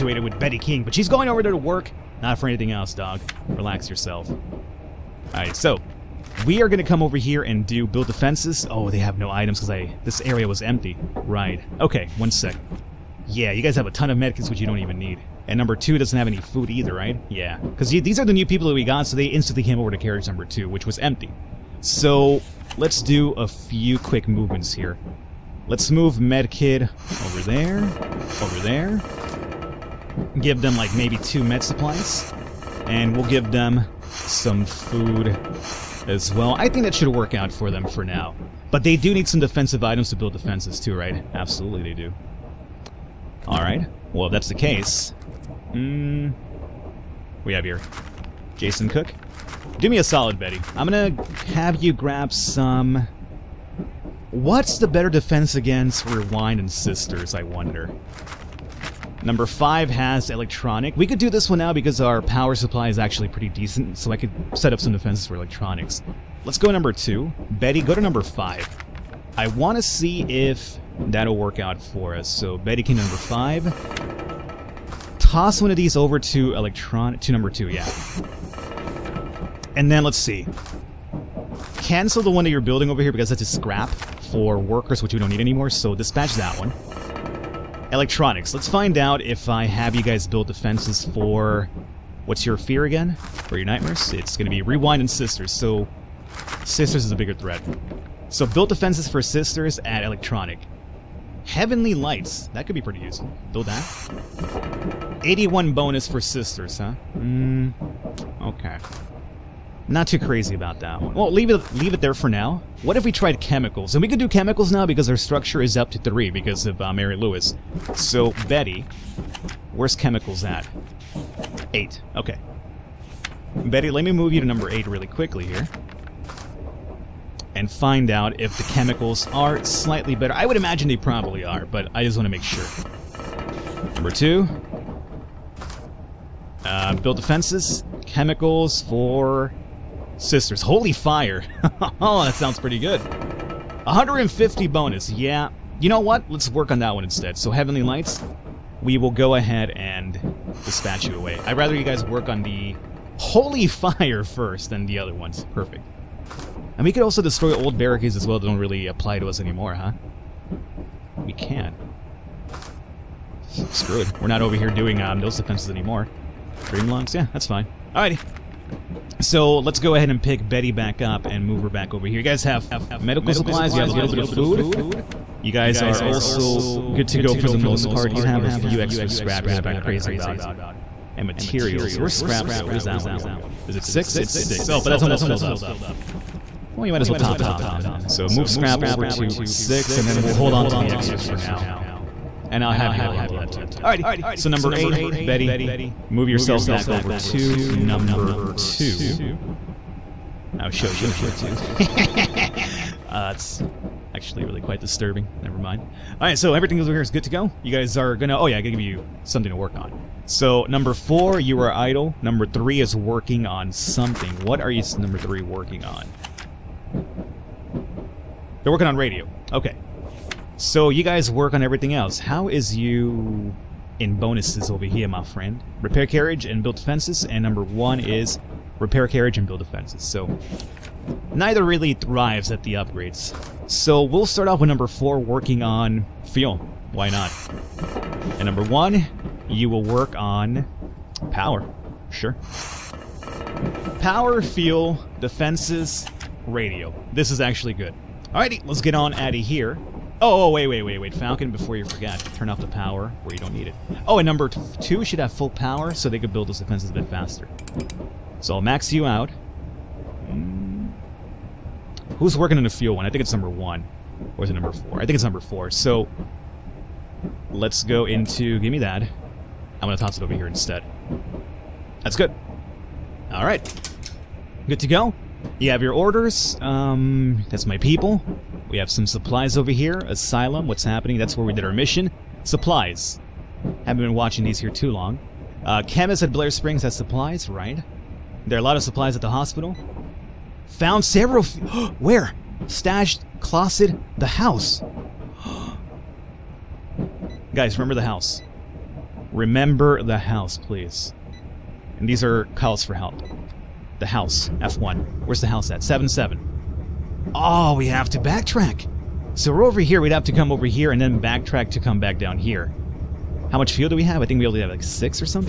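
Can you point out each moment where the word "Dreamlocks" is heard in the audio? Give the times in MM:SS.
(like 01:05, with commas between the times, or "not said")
02:46.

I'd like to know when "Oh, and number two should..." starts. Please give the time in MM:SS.
04:14.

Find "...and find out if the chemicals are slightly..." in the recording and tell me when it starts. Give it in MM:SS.
02:07.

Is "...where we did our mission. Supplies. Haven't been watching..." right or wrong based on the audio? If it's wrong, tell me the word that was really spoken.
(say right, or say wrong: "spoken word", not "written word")
right.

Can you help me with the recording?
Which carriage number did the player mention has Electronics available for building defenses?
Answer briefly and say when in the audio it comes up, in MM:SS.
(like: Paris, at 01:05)
5, at 00:59.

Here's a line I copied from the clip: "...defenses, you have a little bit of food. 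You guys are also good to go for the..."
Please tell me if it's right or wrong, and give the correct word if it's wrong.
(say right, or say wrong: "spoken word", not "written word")
wrong: "supplies", not "defenses".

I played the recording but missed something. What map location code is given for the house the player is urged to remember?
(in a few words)
7 7.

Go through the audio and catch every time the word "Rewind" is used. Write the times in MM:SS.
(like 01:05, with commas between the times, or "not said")
00:56, 01:34.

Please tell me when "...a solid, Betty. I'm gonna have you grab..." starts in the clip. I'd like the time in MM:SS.
00:49.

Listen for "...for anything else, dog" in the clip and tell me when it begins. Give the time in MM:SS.
00:02.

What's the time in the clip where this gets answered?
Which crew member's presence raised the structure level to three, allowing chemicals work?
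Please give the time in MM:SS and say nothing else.
01:56.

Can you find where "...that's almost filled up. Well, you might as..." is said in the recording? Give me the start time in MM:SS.
03:04.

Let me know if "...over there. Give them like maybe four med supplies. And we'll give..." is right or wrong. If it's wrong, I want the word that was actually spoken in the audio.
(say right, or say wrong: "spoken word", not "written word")
wrong: "two", not "four".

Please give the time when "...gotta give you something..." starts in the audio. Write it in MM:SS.
03:28.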